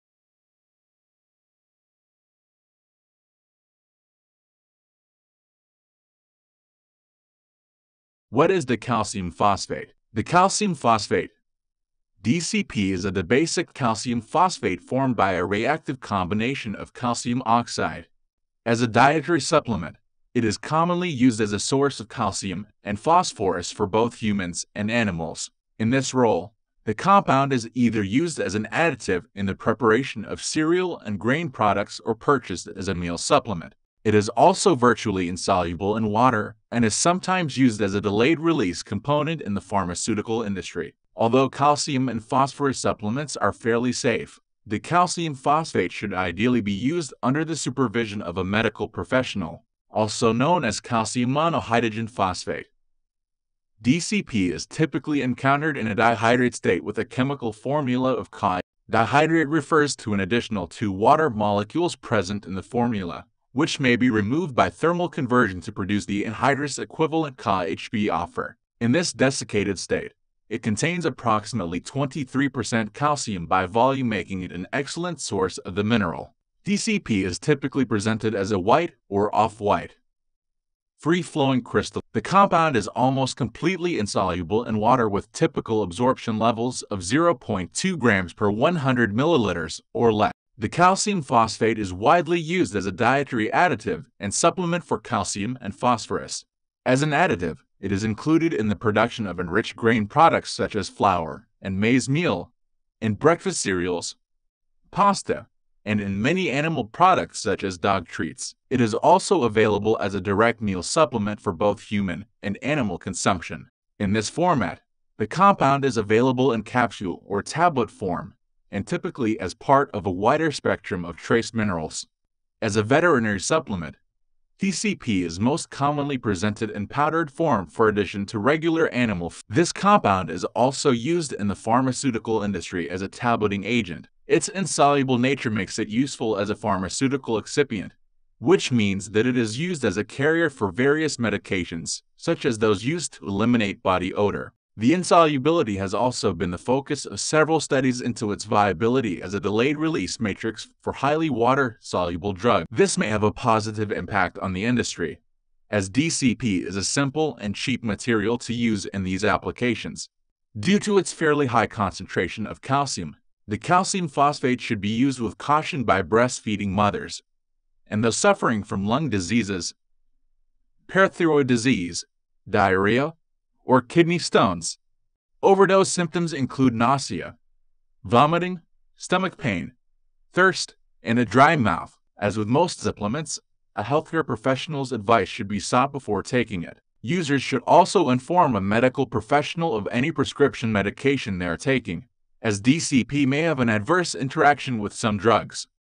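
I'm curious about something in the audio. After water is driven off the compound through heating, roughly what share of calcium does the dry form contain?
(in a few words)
23%.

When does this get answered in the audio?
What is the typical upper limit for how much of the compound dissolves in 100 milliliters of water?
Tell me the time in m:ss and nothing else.
1:26.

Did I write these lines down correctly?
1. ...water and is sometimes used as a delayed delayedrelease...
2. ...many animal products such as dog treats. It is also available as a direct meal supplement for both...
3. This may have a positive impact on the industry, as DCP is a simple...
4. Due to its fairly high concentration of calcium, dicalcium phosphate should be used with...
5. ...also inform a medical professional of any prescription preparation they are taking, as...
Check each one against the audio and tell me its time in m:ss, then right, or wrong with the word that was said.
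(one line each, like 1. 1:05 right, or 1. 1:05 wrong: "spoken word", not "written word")
1. 0:36 wrong: "release", not "delayedrelease"
2. 1:46 right
3. 2:32 right
4. 2:40 right
5. 3:07 wrong: "medication", not "preparation".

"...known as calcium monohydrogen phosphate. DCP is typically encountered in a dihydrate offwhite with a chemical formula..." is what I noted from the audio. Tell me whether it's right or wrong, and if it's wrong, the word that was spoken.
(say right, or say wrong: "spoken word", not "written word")
wrong: "state", not "offwhite".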